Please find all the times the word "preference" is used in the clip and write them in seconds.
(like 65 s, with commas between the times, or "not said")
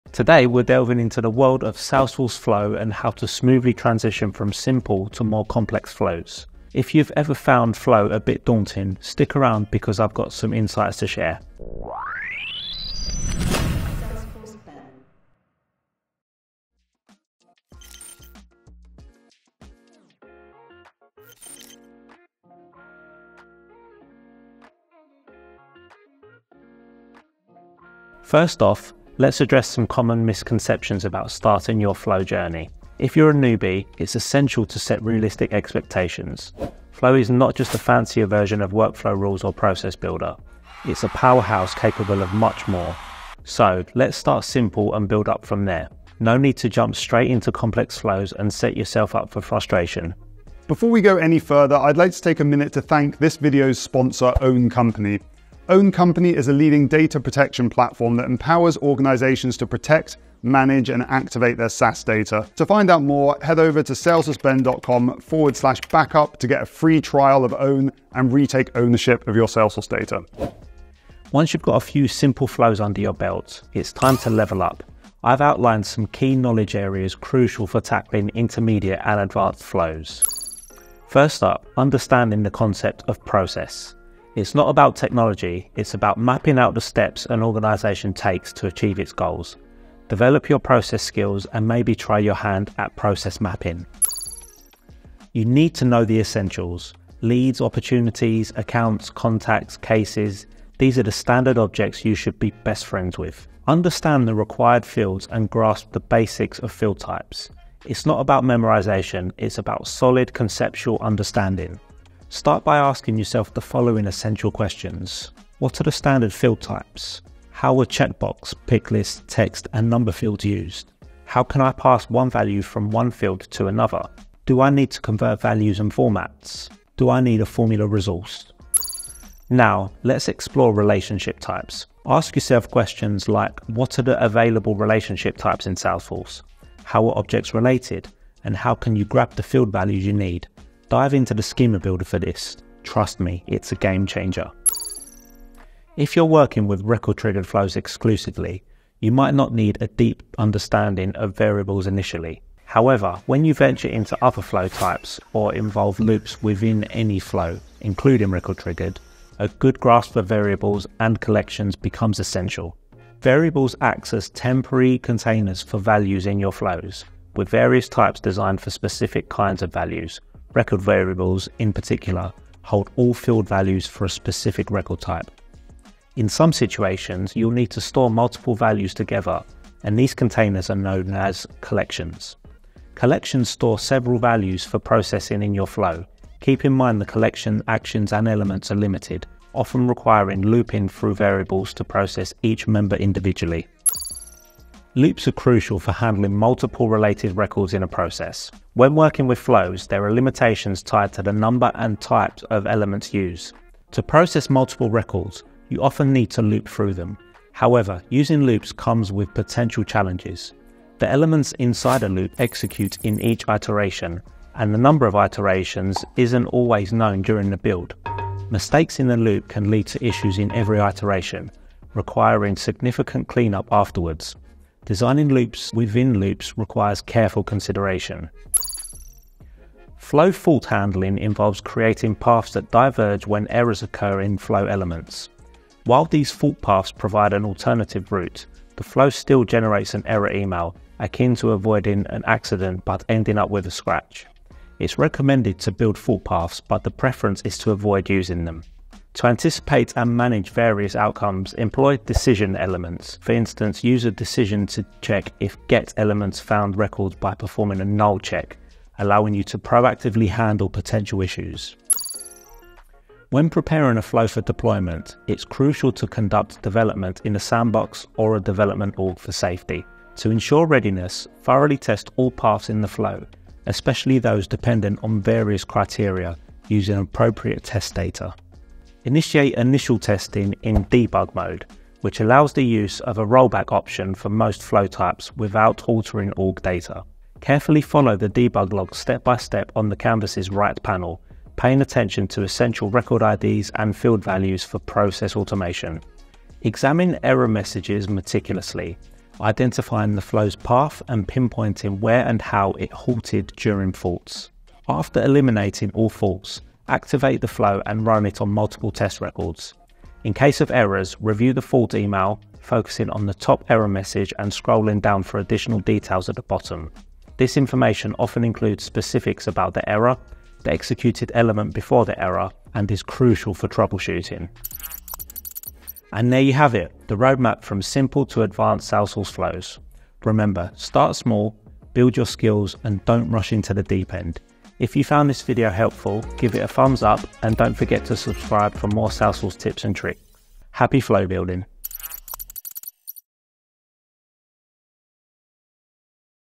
246 s.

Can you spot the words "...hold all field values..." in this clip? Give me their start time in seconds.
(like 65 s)
172 s.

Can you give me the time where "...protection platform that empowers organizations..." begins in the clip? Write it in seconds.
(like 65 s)
57 s.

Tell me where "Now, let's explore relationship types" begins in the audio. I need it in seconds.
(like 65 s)
129 s.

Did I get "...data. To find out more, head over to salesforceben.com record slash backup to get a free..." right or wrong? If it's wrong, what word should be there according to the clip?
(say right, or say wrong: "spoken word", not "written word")
wrong: "forward", not "record".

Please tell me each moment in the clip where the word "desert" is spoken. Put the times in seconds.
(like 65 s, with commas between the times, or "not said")
not said.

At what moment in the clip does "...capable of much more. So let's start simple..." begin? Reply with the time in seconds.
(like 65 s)
41 s.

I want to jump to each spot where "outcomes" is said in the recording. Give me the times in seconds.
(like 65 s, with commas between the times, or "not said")
250 s.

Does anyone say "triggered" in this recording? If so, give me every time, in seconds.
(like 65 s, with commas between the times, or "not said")
147 s, 158 s.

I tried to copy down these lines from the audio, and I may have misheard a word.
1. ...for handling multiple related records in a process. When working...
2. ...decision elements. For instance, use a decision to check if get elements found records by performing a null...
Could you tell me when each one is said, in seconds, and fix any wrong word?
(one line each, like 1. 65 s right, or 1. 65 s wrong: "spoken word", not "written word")
1. 195 s right
2. 251 s right.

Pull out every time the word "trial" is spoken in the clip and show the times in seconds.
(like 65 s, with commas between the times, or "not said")
66 s.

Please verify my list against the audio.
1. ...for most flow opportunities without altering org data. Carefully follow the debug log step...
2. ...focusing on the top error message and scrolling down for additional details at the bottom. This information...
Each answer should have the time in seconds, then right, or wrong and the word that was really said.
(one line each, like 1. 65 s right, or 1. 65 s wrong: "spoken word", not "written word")
1. 284 s wrong: "types", not "opportunities"
2. 312 s right.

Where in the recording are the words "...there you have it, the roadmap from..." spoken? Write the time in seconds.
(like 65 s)
326 s.